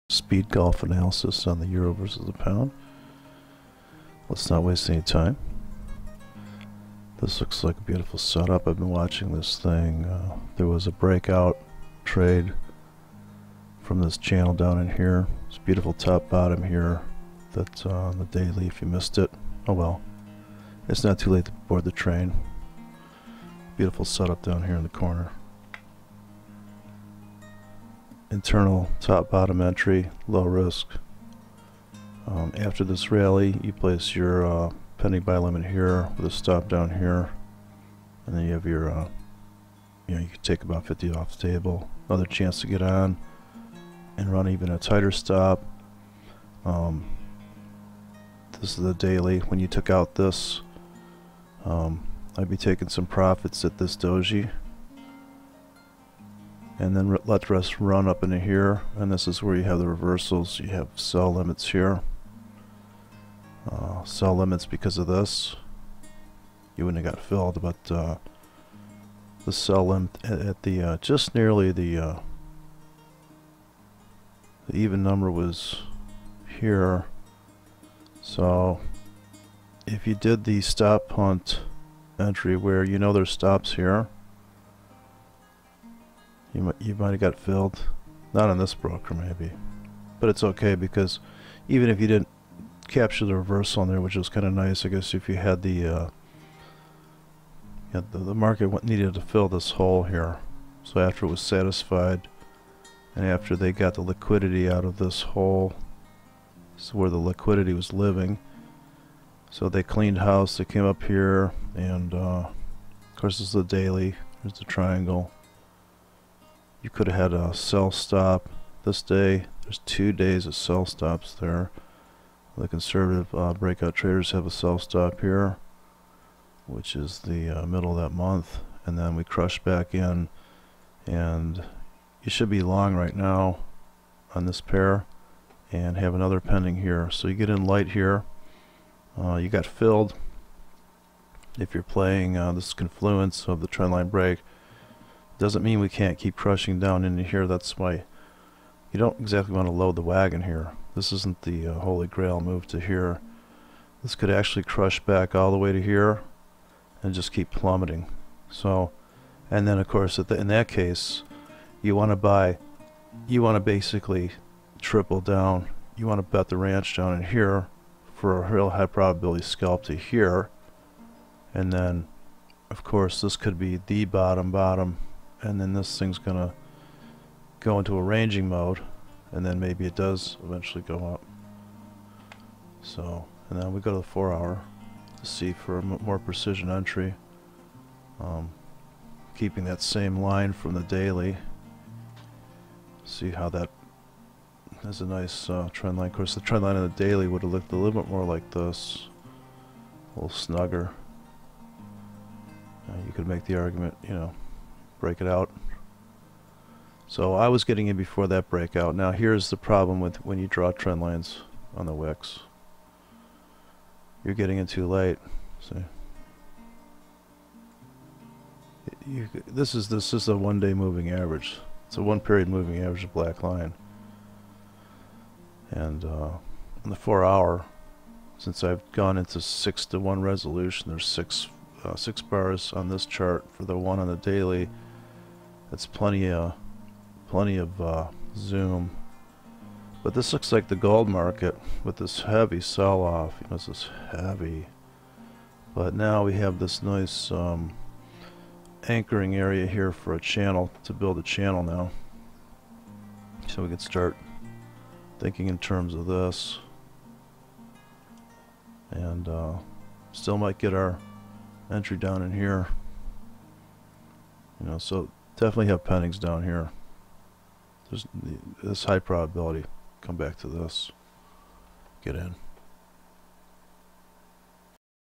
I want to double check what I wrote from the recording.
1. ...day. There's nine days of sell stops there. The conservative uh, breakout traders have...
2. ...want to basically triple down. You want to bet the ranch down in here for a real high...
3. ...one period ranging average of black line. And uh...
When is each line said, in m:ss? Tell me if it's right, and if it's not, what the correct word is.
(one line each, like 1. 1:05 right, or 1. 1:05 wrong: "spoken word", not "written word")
1. 1:59 wrong: "two", not "nine"
2. 2:43 right
3. 3:42 wrong: "moving", not "ranging".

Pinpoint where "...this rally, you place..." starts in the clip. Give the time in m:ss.
0:32.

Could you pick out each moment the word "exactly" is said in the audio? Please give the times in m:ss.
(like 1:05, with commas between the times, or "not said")
2:29.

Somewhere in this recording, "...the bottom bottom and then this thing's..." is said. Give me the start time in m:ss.
2:53.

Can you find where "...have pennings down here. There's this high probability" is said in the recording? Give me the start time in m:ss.
4:25.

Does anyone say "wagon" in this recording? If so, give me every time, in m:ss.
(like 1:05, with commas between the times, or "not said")
2:30.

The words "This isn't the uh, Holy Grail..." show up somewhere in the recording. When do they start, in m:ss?
2:30.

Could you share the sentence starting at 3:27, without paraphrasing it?
So I was getting in before that breakout.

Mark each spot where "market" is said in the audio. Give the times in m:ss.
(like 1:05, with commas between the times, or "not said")
1:38, 4:01.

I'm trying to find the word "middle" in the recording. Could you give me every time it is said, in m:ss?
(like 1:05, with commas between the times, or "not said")
2:07.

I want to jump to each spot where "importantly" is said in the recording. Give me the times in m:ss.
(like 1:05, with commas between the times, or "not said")
not said.